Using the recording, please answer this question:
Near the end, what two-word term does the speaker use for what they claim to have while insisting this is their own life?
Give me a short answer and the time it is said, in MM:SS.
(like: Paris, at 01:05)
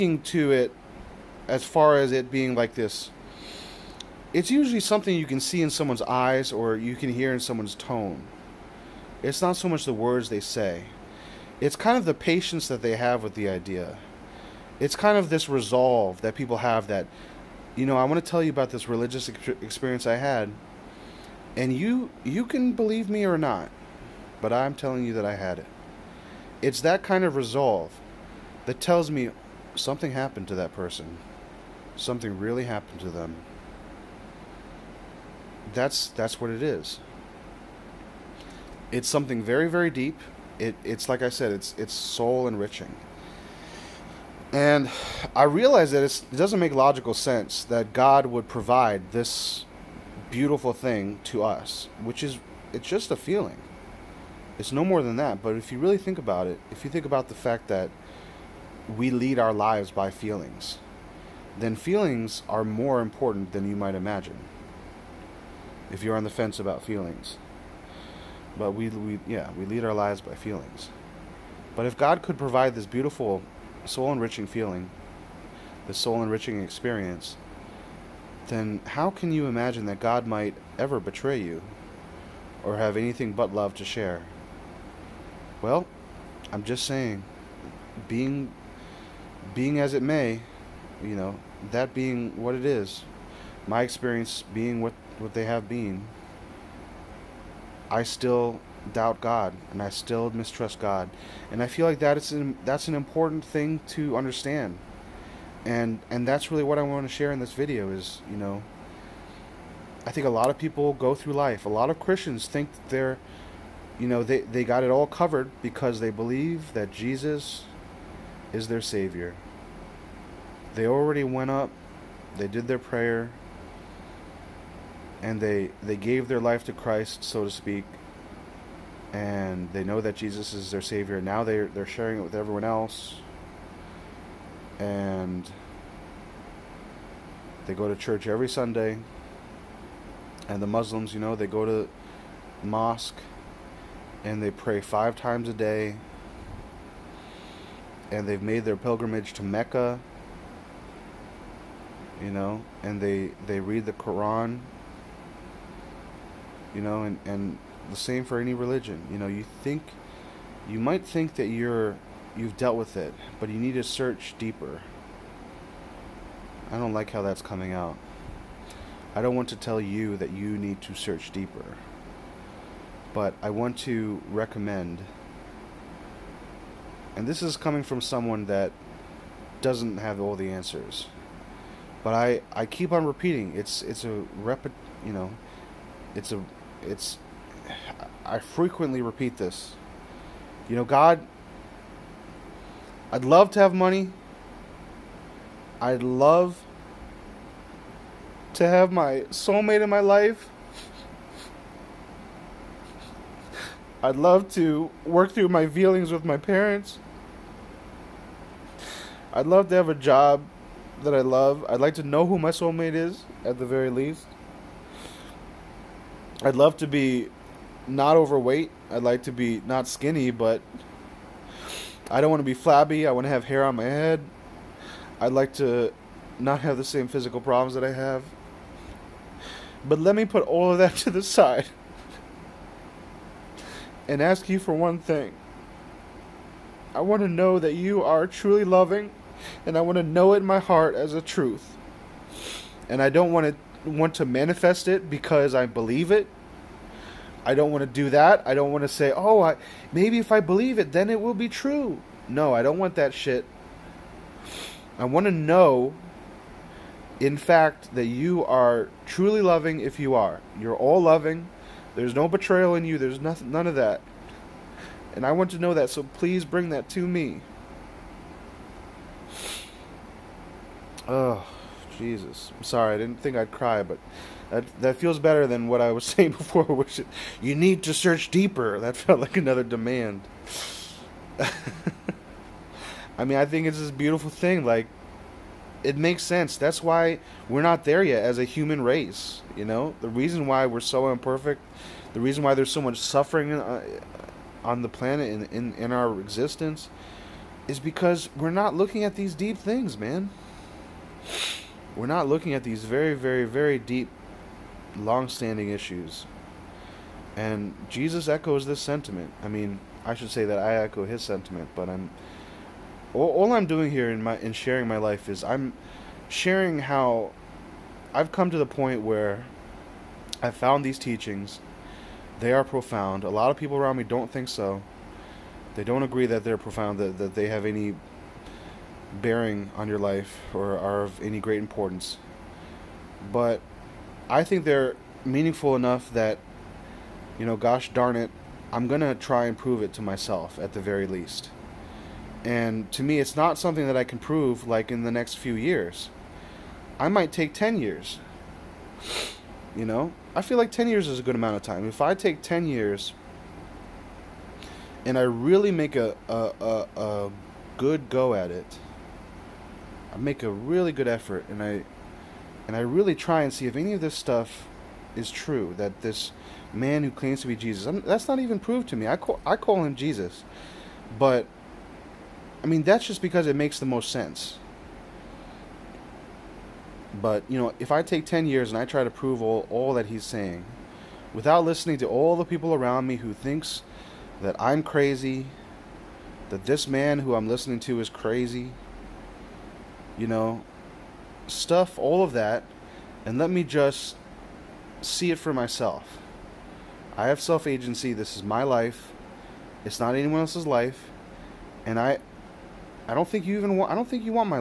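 self agency, at 06:37.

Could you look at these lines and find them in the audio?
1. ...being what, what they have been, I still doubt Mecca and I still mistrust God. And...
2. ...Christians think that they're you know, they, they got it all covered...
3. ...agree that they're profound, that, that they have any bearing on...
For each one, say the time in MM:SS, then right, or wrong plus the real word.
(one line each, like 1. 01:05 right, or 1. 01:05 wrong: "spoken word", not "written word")
1. 01:34 wrong: "God", not "Mecca"
2. 01:51 right
3. 05:26 right.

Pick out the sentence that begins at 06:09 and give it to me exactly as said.
I call I call him Jesus, but I mean that's just because it makes the most sense.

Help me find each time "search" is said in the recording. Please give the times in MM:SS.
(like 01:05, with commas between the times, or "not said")
02:43, 02:50, 04:37.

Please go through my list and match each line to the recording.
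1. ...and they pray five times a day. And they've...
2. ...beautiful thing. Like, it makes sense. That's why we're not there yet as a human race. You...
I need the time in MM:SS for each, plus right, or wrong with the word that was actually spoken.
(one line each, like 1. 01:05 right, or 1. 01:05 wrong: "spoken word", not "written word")
1. 02:24 right
2. 04:43 right.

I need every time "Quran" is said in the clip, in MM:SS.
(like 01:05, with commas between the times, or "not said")
02:33.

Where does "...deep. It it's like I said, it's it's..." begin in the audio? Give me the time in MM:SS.
00:39.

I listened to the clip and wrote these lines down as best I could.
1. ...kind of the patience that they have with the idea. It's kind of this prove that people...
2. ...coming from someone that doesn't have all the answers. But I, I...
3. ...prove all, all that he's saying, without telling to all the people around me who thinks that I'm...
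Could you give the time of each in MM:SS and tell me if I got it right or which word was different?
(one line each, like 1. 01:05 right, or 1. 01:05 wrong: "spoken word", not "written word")
1. 00:11 wrong: "resolve", not "prove"
2. 02:57 right
3. 06:19 wrong: "listening", not "telling".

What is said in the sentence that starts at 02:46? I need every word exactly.
I don't like how that's coming out.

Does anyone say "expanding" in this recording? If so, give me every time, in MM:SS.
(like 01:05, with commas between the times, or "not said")
not said.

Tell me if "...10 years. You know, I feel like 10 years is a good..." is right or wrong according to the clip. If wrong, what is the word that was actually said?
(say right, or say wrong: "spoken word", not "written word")
right.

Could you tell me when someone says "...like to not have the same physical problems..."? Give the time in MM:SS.
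03:45.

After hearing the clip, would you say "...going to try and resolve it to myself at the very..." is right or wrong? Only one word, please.
wrong.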